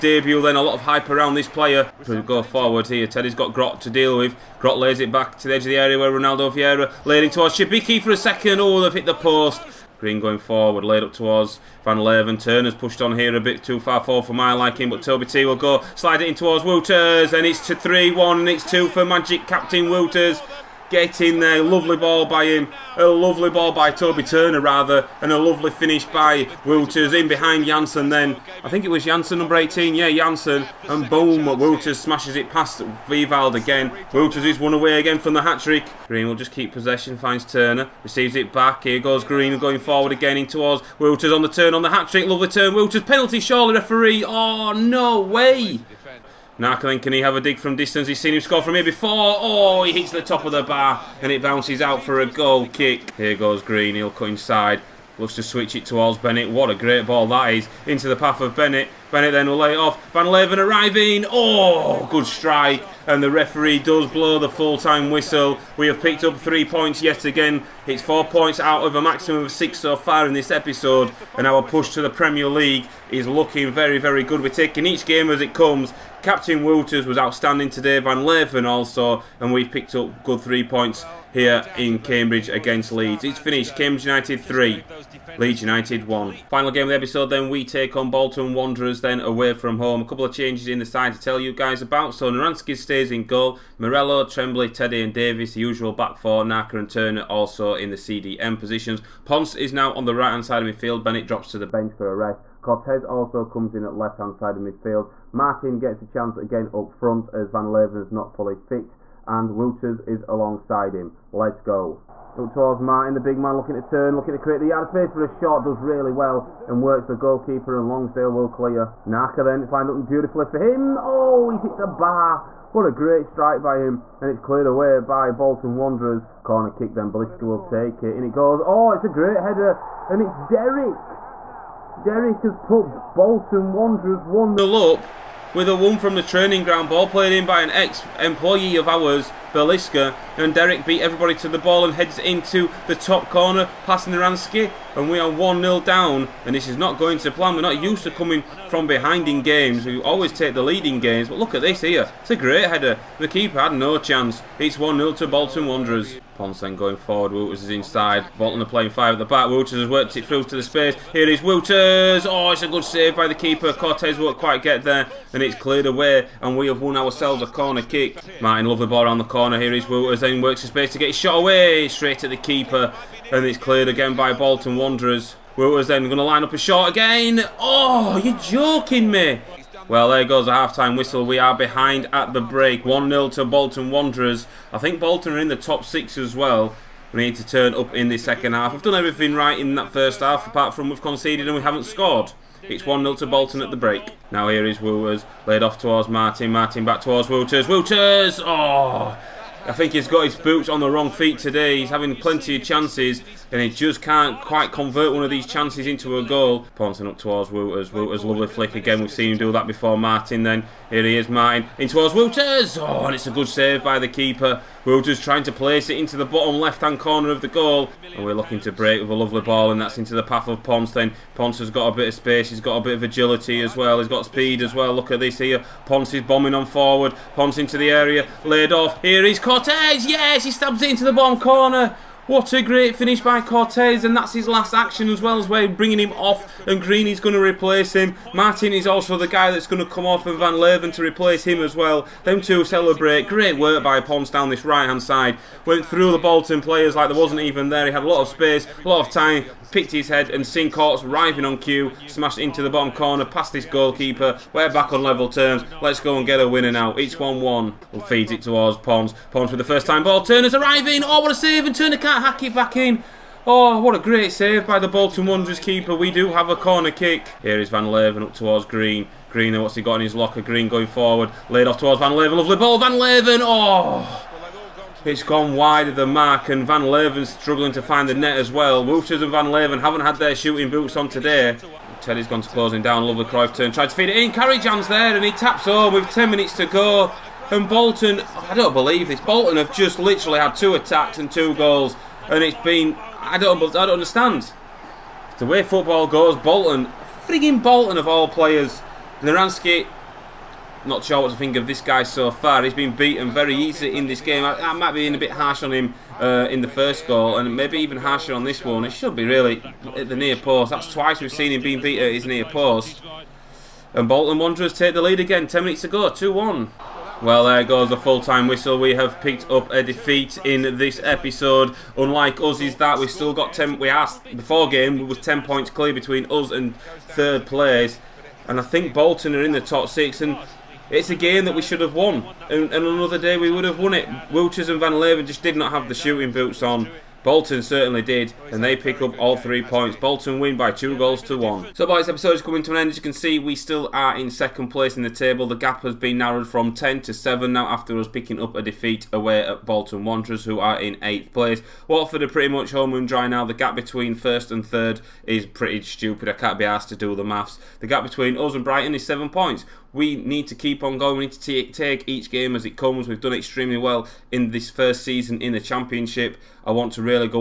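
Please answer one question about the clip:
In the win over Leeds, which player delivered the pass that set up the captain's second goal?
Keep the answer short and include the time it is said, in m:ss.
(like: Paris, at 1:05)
Toby Turner, at 0:23.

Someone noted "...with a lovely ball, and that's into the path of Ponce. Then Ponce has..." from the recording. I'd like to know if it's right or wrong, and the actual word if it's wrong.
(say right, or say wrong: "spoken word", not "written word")
right.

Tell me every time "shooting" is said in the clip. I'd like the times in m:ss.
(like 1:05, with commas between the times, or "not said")
4:40, 5:35.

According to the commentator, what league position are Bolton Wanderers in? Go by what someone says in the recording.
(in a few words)
8th.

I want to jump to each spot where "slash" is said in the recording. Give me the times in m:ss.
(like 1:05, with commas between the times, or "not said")
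not said.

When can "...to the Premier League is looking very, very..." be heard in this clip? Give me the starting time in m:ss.
1:11.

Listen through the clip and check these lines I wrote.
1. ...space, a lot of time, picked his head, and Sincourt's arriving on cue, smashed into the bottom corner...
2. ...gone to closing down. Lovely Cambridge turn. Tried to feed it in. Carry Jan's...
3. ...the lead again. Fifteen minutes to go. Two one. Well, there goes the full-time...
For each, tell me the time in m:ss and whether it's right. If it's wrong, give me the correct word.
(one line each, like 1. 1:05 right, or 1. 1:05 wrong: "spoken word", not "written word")
1. 4:08 right
2. 4:42 wrong: "Cruyff", not "Cambridge"
3. 5:14 wrong: "Ten", not "Fifteen".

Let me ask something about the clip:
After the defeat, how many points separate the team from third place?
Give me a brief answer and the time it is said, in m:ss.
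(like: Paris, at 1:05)
7, at 5:47.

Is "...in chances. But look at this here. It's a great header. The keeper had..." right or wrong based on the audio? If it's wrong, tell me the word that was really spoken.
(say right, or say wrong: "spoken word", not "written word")
wrong: "games", not "chances".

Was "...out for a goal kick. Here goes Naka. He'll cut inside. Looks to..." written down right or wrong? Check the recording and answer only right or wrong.
wrong.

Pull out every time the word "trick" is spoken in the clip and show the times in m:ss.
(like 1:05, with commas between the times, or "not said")
0:35, 0:41.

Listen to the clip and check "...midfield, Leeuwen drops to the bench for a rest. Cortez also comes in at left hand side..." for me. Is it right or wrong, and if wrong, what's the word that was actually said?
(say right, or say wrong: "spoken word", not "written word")
wrong: "Bennett", not "Leeuwen".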